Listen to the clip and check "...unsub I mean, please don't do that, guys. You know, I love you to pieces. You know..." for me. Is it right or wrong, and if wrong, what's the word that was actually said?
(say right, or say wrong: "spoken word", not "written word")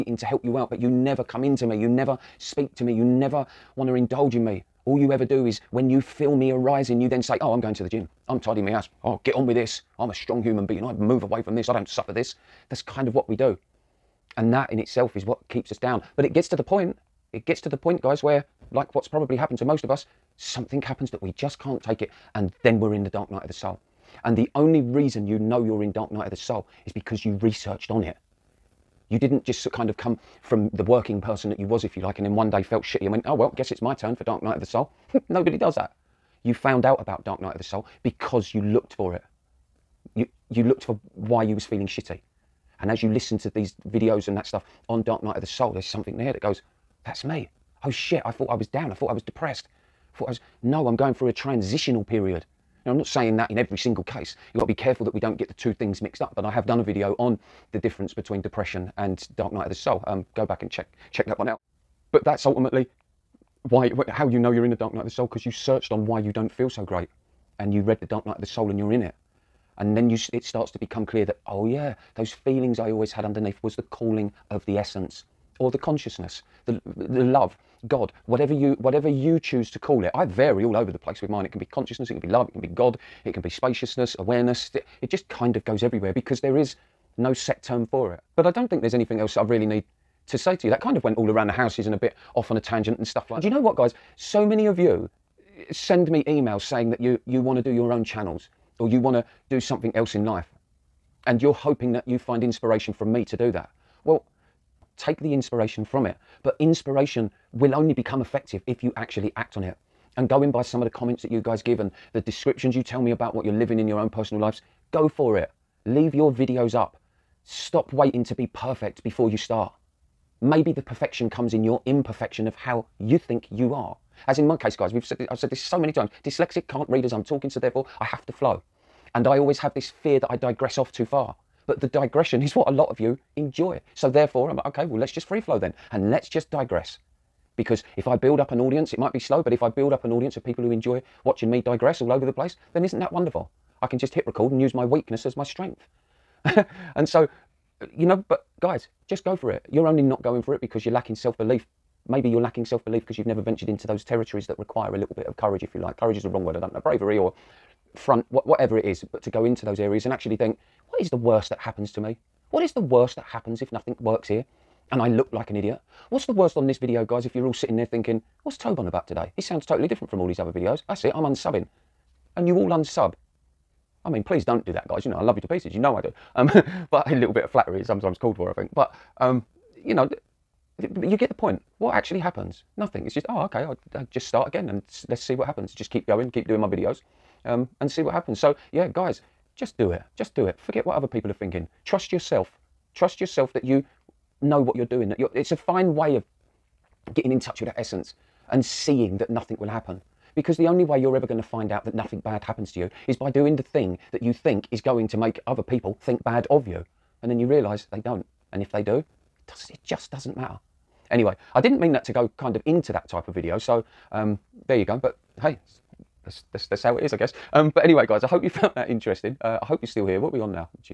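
right.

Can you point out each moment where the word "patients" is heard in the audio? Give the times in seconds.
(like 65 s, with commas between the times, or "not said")
not said.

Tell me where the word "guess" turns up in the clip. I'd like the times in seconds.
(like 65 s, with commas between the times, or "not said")
33 s, 217 s.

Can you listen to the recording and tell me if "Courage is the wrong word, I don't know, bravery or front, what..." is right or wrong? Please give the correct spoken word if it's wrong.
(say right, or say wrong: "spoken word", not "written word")
right.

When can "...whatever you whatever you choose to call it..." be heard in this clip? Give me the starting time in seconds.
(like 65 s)
78 s.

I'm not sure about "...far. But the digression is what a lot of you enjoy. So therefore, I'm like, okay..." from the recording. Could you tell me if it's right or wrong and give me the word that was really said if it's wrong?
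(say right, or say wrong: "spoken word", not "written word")
right.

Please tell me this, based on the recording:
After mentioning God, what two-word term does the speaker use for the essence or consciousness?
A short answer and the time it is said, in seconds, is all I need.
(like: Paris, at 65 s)
spaciousness awareness, at 83 s.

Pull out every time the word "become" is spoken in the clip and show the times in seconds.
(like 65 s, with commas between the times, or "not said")
70 s, 107 s.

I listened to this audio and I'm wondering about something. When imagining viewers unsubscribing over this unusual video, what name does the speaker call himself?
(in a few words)
Toby.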